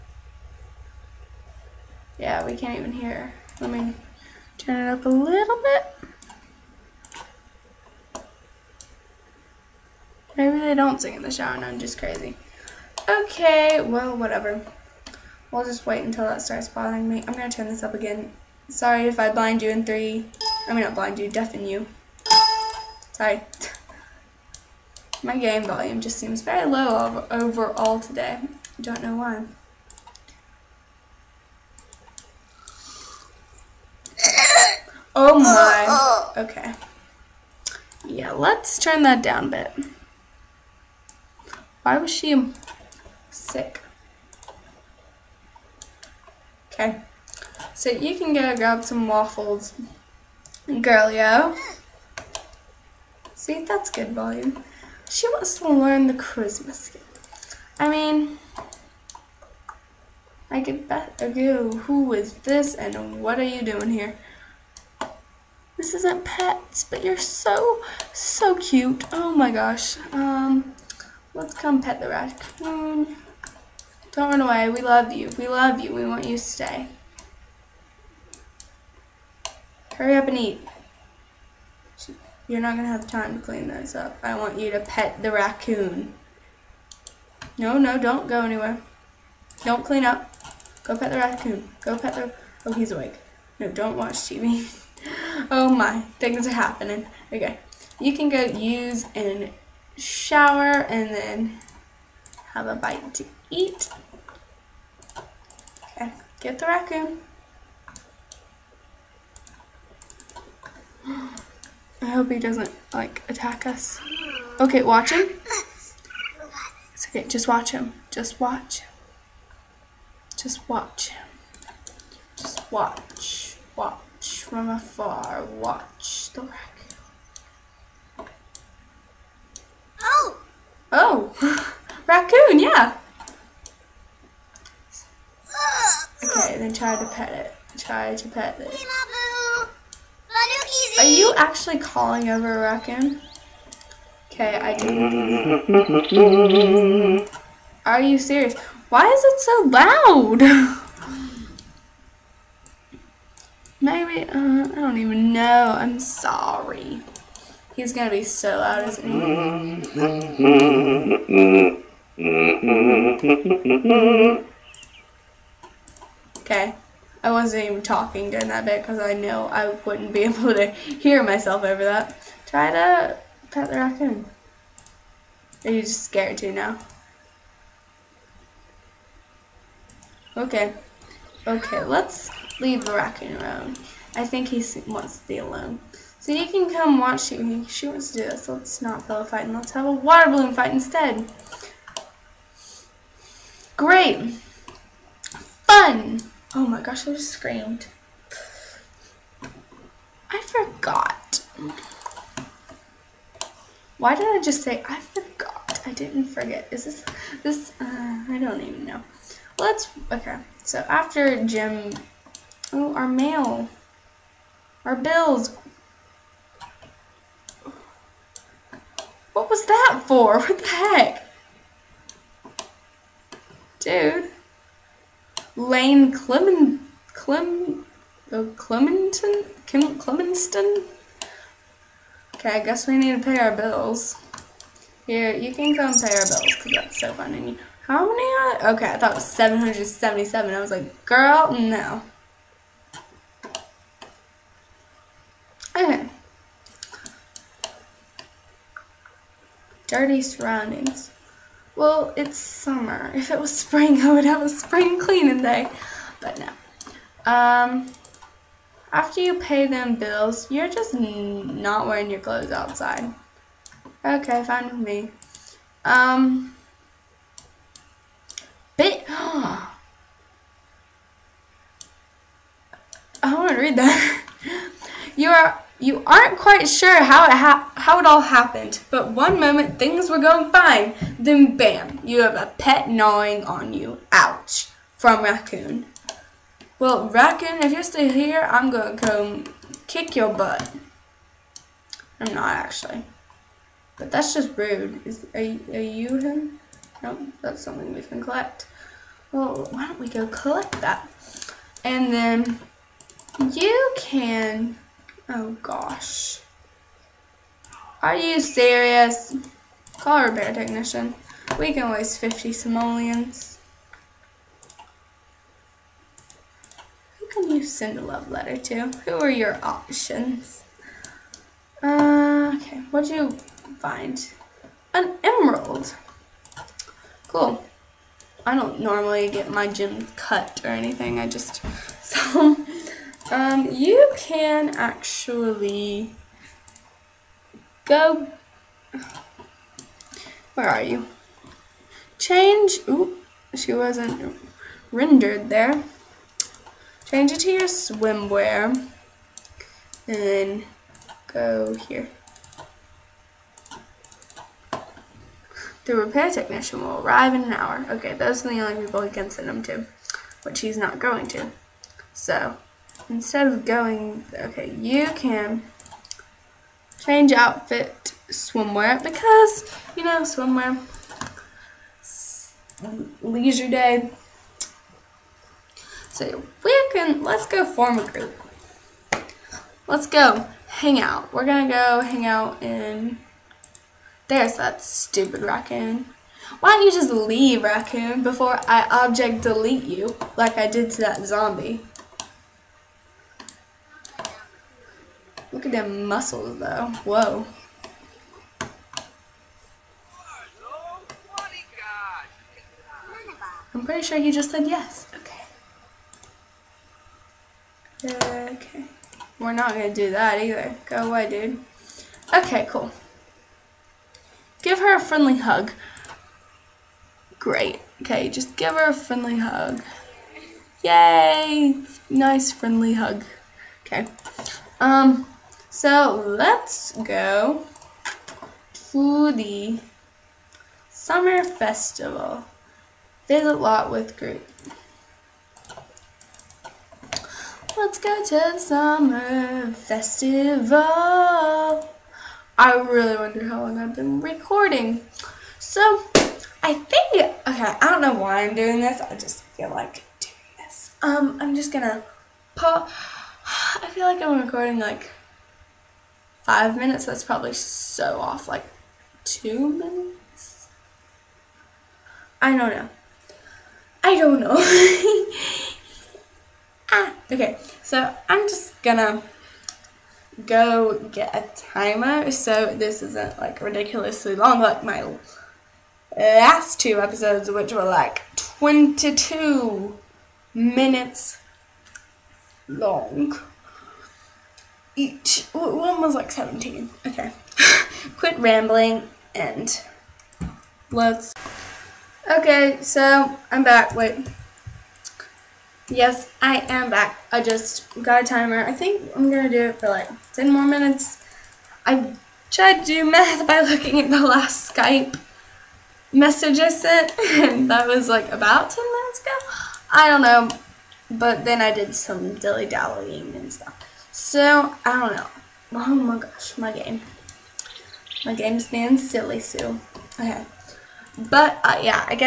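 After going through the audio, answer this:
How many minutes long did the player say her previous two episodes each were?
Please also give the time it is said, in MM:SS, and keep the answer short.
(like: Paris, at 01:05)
22, at 07:58.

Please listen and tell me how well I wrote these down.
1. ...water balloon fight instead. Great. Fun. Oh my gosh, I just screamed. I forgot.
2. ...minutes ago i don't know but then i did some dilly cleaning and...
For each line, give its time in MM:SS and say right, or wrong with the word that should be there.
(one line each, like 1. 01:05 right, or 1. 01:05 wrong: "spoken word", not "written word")
1. 03:09 right
2. 08:28 wrong: "dallying", not "cleaning".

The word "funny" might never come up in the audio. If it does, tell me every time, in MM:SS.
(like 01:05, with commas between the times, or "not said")
03:57.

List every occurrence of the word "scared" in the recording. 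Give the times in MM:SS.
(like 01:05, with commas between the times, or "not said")
02:56.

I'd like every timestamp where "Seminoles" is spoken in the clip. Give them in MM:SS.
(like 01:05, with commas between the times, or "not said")
not said.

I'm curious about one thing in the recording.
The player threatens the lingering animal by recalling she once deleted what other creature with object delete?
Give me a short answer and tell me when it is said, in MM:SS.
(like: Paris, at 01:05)
Zombie, at 06:31.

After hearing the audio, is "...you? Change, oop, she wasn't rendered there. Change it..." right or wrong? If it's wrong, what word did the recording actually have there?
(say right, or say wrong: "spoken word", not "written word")
right.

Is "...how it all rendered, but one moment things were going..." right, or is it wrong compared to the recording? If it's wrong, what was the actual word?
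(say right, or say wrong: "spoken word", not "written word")
wrong: "happened", not "rendered".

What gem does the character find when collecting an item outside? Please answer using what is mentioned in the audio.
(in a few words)
Emerald.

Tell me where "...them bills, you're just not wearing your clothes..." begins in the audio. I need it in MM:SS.
04:19.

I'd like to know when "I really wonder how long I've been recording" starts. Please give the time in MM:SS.
07:22.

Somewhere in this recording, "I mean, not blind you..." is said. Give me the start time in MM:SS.
00:20.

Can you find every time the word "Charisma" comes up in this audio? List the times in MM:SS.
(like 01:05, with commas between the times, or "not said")
00:56.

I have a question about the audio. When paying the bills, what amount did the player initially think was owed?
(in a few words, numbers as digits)
777.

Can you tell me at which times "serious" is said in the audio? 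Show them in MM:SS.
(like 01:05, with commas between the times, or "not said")
02:28, 05:08.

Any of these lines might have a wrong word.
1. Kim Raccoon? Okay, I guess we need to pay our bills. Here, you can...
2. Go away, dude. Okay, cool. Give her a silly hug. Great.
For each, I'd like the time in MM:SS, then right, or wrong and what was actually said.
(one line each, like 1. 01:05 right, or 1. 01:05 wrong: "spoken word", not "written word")
1. 03:49 wrong: "Clemenston", not "Raccoon"
2. 06:50 wrong: "friendly", not "silly".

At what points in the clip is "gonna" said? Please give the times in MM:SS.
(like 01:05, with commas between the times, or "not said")
02:37, 04:48, 07:31, 07:48, 08:19.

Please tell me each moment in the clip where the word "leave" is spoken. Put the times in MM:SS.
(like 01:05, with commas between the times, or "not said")
03:02, 06:27.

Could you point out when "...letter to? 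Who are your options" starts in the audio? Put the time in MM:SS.
05:18.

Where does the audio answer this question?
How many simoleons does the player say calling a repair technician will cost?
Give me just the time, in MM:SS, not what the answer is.
05:12.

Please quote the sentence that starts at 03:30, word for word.
So after Jim, oh, our mail, our bills, What was that for?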